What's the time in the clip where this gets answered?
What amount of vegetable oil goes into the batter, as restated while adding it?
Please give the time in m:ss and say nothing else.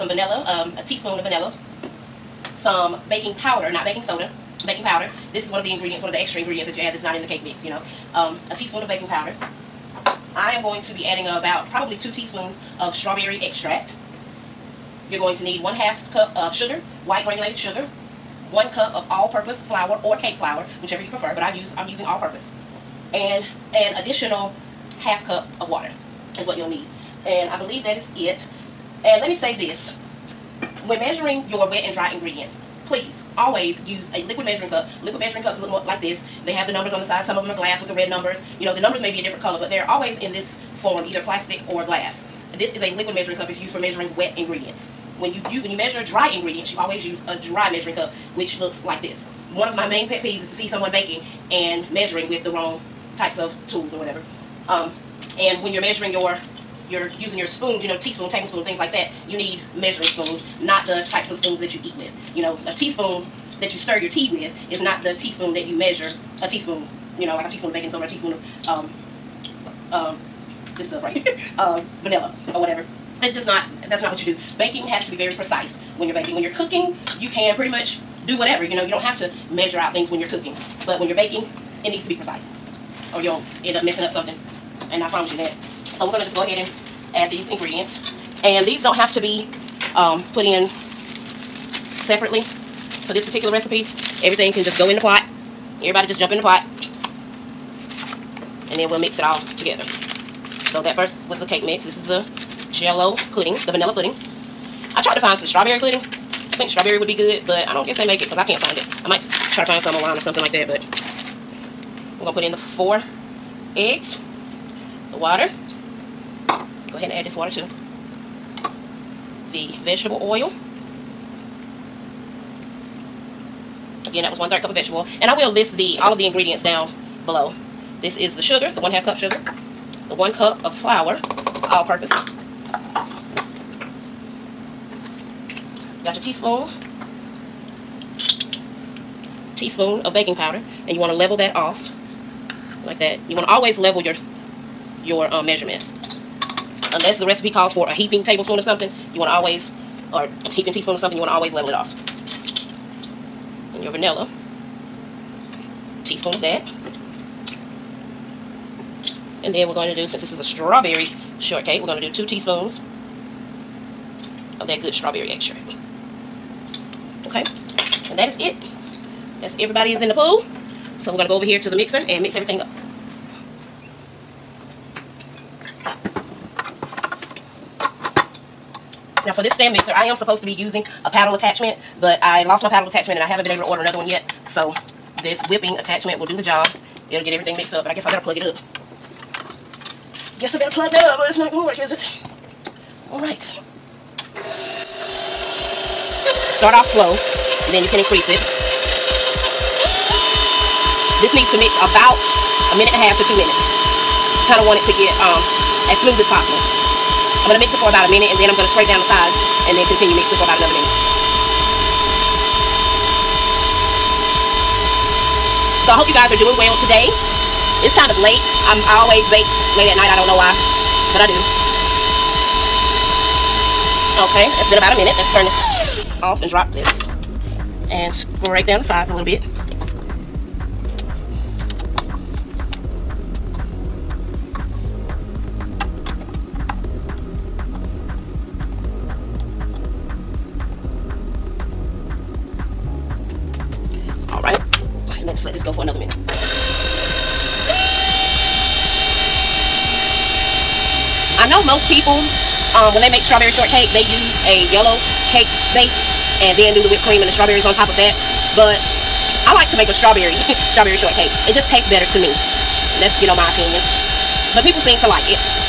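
2:04.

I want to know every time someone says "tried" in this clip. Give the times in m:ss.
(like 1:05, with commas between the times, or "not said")
1:45.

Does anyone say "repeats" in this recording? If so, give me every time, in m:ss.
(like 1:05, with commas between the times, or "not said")
not said.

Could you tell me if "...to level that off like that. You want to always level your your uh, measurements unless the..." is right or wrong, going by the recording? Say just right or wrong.
right.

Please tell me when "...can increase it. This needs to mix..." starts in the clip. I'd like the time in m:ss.
3:17.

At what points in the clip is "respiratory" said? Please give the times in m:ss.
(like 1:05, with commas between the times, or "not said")
not said.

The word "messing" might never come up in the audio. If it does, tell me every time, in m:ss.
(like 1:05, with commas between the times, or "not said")
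1:23.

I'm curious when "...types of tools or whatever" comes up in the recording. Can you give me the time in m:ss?
0:53.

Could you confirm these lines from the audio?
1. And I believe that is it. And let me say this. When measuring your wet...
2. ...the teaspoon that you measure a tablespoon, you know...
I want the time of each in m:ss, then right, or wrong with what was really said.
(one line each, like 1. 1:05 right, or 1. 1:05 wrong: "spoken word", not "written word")
1. 0:27 right
2. 1:05 wrong: "teaspoon", not "tablespoon".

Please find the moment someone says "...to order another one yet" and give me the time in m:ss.
3:03.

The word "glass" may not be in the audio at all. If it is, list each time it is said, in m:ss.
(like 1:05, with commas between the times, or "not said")
0:37, 0:41.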